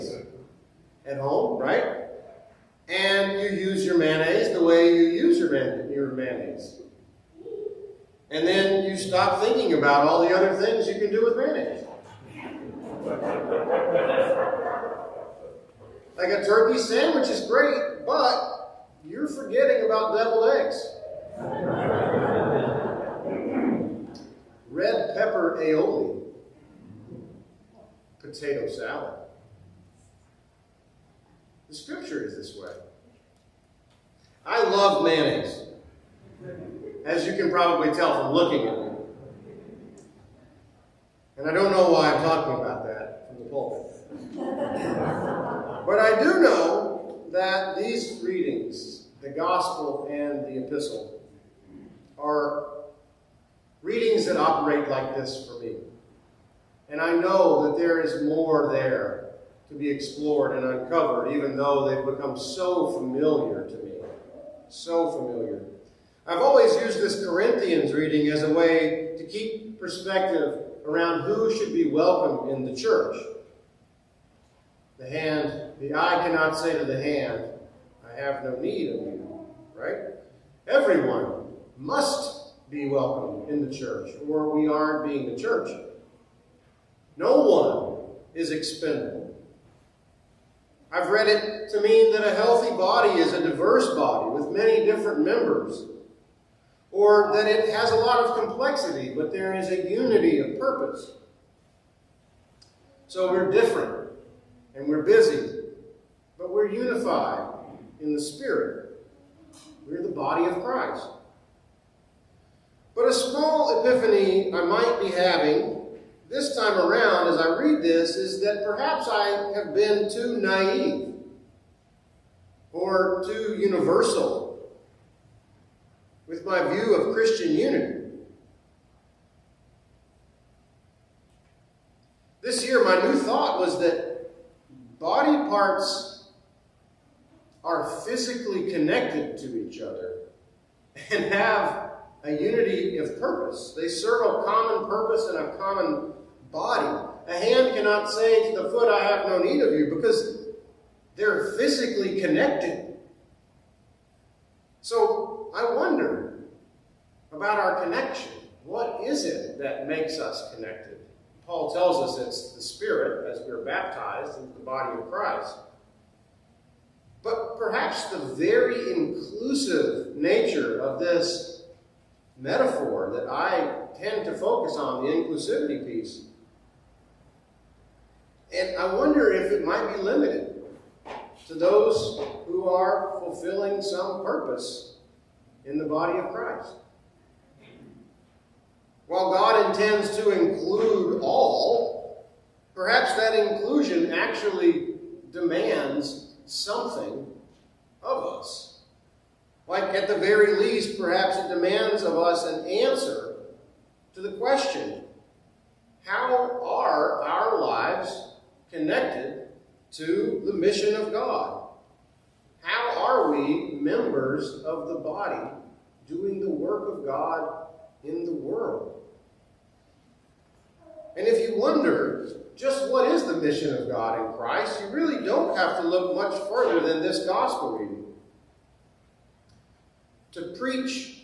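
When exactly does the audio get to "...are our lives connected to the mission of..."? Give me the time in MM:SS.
03:26.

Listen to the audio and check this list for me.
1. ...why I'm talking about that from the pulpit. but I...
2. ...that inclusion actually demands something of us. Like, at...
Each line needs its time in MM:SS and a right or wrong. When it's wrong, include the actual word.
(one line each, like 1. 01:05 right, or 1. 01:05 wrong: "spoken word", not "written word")
1. 00:41 right
2. 03:13 right.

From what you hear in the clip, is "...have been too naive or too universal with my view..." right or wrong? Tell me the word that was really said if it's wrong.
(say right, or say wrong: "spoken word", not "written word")
right.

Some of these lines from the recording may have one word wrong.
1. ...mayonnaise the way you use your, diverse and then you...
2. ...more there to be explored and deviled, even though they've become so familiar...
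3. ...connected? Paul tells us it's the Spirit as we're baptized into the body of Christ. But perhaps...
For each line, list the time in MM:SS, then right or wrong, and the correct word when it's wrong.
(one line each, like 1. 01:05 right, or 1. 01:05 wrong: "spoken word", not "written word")
1. 00:03 wrong: "mayonnaise", not "diverse"
2. 00:58 wrong: "uncovered", not "deviled"
3. 02:40 right.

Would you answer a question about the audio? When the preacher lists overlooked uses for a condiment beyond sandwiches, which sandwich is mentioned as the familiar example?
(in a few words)
Turkey sandwich.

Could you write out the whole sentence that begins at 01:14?
The hand, the eye cannot say to the hand, I have no need of you, right?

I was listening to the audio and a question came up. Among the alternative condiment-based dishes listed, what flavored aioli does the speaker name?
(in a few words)
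Red pepper aioli.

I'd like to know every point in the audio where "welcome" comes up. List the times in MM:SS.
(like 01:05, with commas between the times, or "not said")
01:11, 01:22.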